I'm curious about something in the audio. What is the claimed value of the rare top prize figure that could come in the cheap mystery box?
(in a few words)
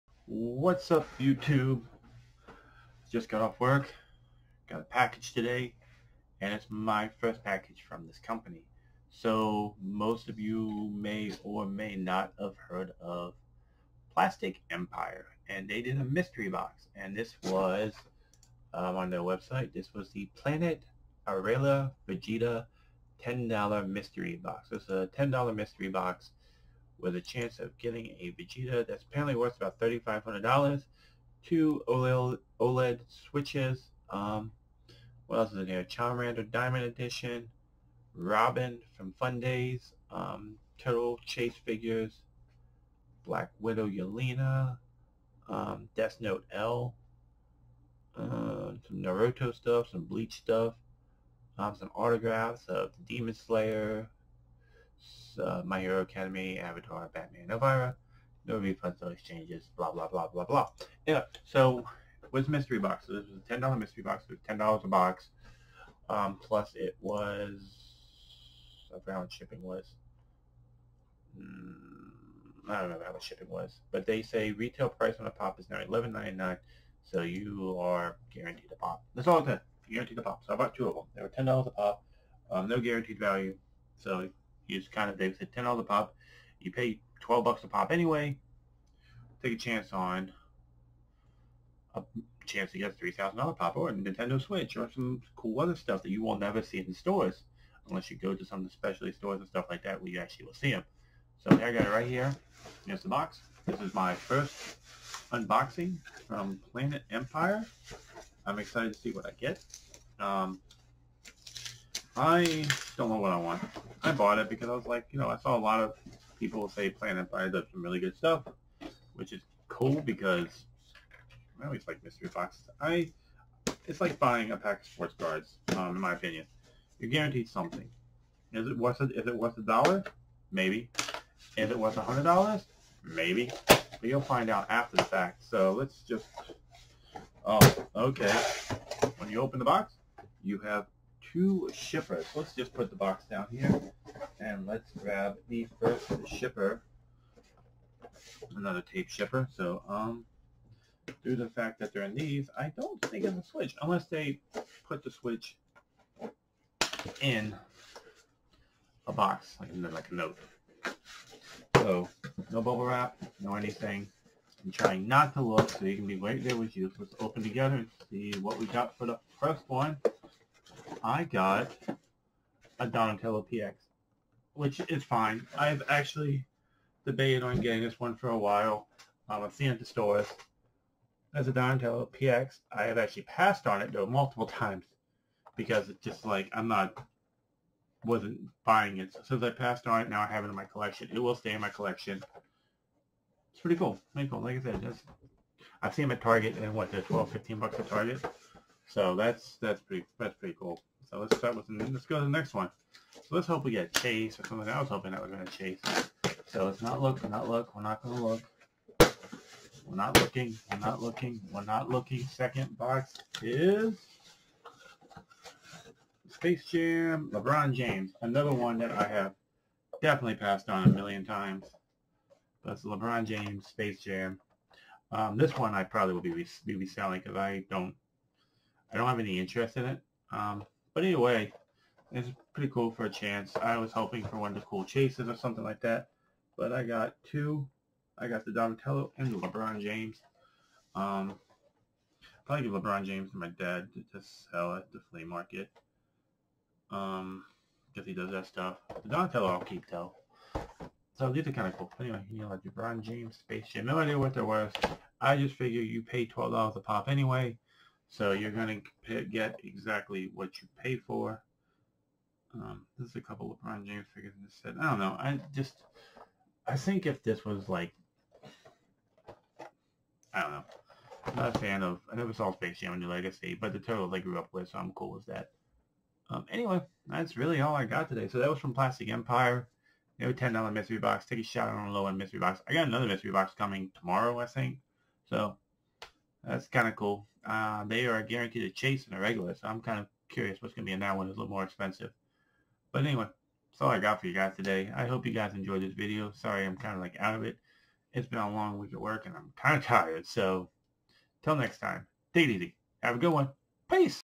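$3,500.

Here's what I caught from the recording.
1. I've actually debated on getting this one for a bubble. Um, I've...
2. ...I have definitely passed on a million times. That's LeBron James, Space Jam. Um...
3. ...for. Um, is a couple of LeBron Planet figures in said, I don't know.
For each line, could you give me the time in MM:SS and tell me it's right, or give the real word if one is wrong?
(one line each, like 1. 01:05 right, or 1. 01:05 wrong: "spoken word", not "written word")
1. 02:55 wrong: "while", not "bubble"
2. 03:38 right
3. 04:20 wrong: "James", not "Planet".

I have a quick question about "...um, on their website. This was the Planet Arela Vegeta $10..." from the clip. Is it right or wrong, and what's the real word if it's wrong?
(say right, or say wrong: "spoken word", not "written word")
right.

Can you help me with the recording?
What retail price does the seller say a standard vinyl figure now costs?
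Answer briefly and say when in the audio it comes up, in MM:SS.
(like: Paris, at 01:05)
$11.99, at 01:15.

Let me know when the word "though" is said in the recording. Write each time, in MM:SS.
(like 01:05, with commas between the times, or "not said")
03:03, 04:09.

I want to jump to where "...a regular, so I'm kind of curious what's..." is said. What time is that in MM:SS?
04:49.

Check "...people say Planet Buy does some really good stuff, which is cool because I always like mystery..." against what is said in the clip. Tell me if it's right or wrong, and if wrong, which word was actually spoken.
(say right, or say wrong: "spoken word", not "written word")
right.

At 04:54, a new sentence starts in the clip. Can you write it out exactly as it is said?
I hope you guys enjoyed this video.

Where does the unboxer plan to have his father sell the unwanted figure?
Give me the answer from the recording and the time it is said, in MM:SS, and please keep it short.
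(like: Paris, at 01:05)
flea market, at 04:05.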